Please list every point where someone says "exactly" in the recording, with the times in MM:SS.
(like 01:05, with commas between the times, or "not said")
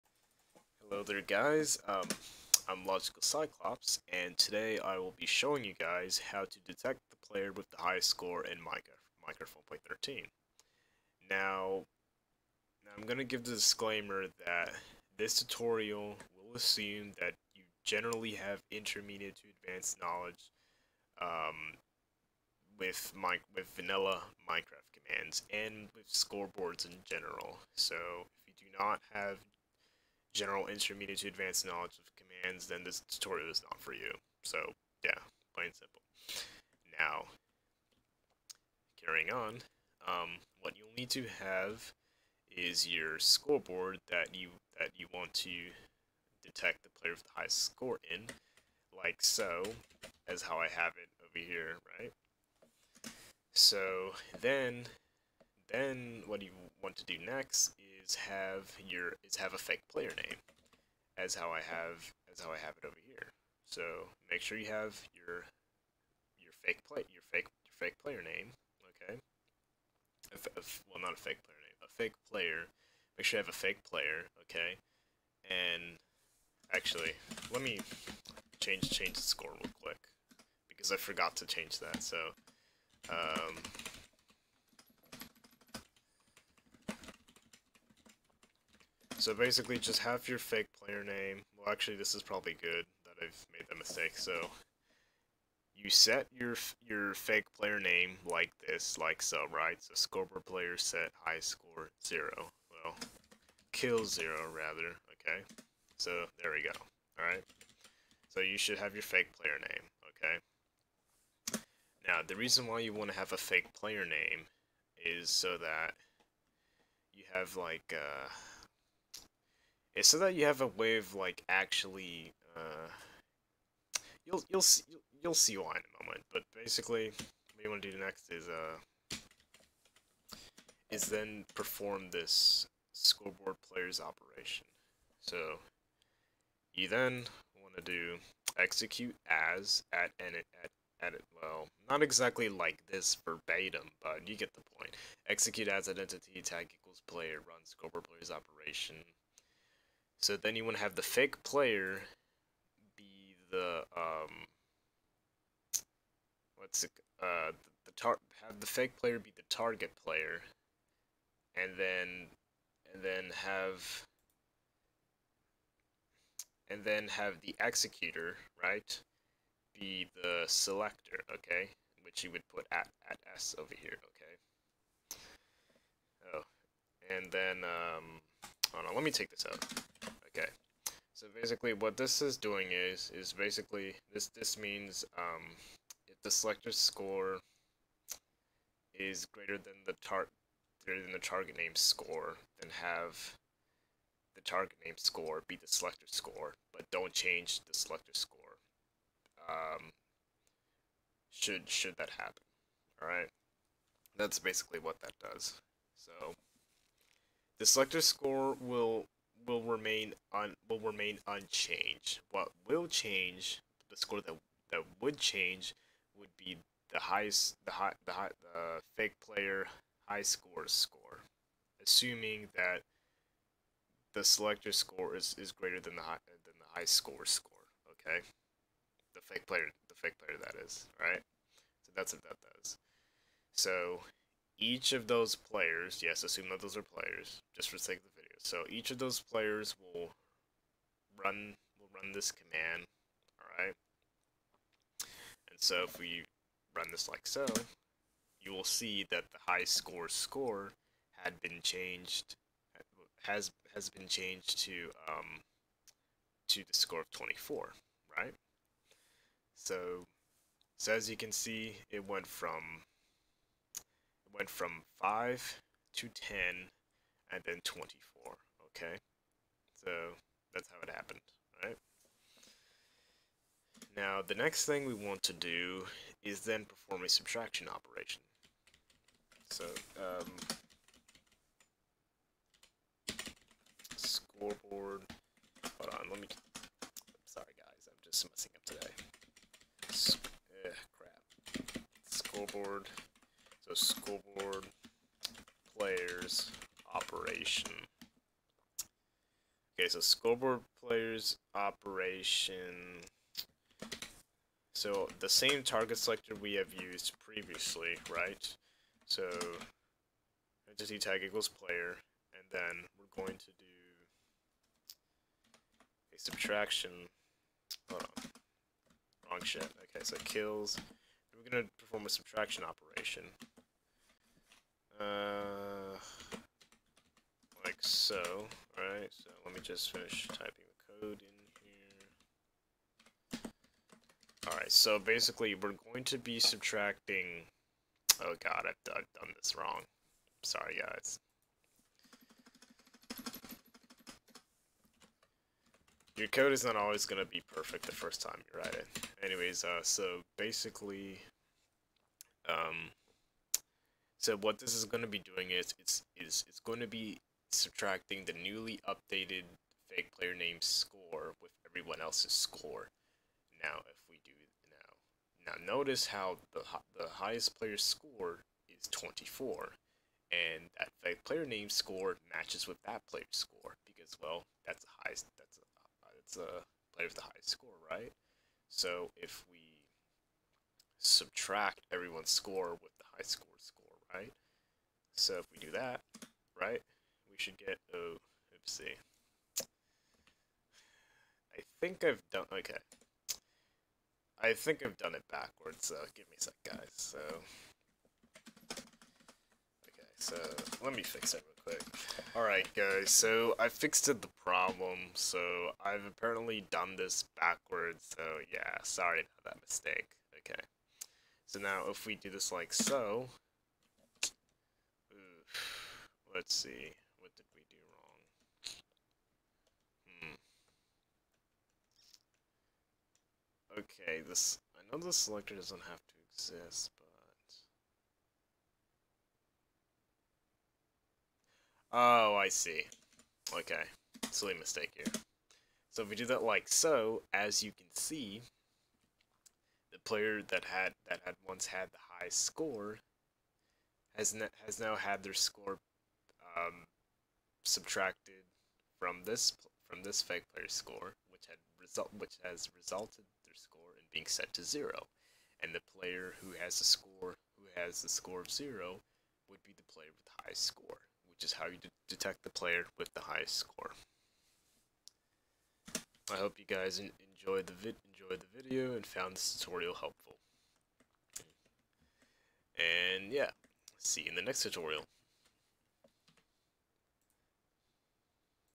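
02:22.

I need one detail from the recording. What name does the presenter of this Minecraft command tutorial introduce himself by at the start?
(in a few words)
Logical Cyclops.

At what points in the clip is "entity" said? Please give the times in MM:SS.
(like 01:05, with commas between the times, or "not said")
02:25, 05:10.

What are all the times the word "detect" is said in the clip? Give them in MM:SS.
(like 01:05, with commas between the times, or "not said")
00:06, 00:46, 07:42.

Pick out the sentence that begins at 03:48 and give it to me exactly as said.
Okay, the fake player the fake player that is right.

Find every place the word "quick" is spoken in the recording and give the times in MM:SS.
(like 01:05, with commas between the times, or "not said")
01:19, 06:41.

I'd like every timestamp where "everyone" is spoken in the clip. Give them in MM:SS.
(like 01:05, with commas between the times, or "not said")
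06:01, 06:21.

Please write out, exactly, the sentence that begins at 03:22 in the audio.
All right, that's basically what that does.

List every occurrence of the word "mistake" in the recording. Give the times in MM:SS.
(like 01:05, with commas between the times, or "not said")
01:33, 06:49, 07:14.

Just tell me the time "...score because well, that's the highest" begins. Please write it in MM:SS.
06:13.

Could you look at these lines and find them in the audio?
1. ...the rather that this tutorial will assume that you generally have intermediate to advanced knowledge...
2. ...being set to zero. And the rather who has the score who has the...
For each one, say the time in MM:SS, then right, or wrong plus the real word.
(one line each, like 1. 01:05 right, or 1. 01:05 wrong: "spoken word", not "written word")
1. 00:13 wrong: "disclaimer", not "rather"
2. 07:34 wrong: "player", not "rather".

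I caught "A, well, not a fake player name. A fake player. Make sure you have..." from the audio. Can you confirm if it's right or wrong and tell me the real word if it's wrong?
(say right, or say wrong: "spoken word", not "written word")
right.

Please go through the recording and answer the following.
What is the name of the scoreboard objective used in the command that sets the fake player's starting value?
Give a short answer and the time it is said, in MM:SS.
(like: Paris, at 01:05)
kill, at 01:43.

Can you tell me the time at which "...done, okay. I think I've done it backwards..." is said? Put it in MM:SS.
06:32.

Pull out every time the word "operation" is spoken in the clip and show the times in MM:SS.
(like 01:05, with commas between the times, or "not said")
02:13, 02:28, 04:37, 04:56, 05:01, 05:22.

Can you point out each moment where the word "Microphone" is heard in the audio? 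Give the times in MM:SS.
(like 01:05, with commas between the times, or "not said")
00:09.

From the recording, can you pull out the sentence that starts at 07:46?
I hope you guys enjoyed the vid enjoyed the video and found this tutorial helpful.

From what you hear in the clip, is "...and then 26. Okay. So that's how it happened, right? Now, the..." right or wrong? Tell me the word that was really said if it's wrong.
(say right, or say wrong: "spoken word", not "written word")
wrong: "24", not "26".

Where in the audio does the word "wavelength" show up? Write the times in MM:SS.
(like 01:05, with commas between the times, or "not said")
not said.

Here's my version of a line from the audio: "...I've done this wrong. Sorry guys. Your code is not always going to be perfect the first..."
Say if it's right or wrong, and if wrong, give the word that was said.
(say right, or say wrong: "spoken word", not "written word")
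right.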